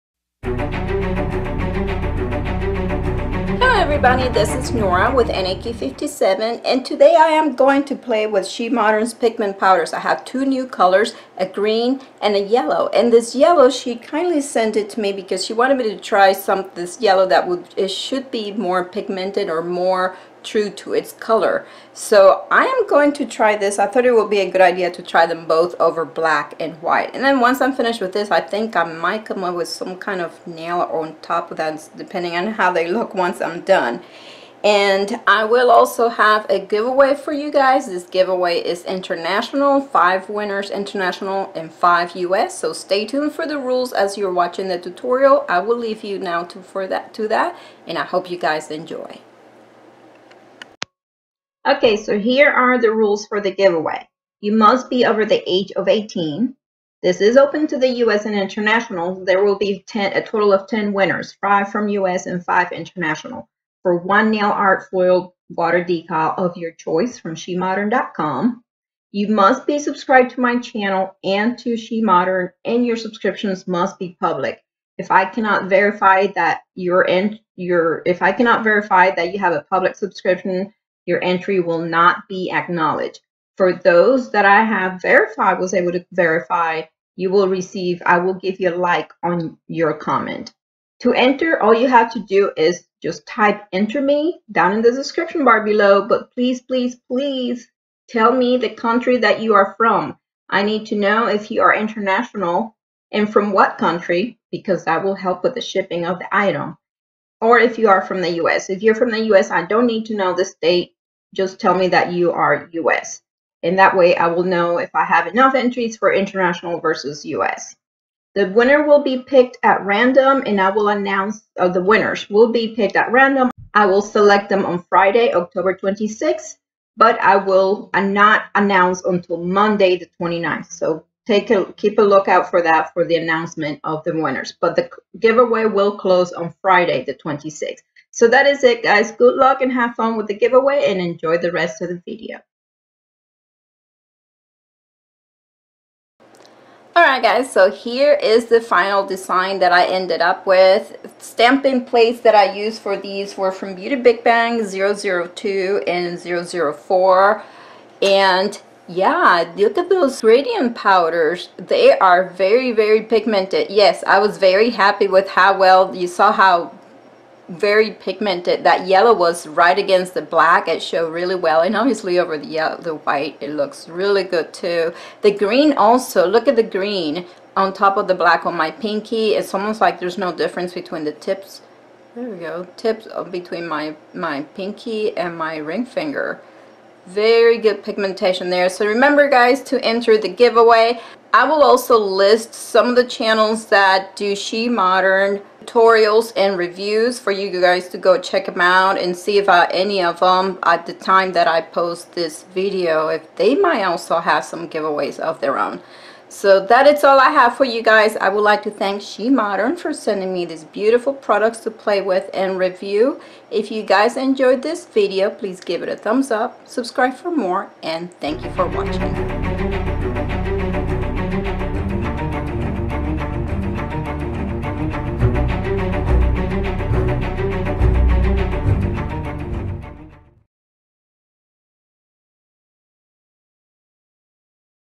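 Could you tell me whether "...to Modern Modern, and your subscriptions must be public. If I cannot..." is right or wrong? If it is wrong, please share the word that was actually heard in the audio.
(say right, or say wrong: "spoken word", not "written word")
wrong: "She", not "Modern".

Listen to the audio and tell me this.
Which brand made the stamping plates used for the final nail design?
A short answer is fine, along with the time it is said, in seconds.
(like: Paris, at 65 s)
Beauty Big Bang, at 153 s.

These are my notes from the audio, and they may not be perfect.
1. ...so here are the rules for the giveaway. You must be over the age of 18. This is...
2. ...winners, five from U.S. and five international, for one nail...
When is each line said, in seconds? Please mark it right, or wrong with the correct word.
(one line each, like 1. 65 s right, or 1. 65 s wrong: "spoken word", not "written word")
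1. 51 s right
2. 60 s right.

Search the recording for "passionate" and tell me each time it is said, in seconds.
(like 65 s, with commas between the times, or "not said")
not said.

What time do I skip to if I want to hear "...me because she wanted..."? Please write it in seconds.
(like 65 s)
15 s.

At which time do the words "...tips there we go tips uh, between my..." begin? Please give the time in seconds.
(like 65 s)
181 s.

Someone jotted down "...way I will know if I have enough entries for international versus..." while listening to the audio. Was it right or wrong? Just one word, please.
right.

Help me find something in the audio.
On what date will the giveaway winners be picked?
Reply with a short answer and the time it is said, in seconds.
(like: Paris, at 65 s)
Friday, October 26th, at 125 s.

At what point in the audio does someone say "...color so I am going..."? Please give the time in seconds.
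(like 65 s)
21 s.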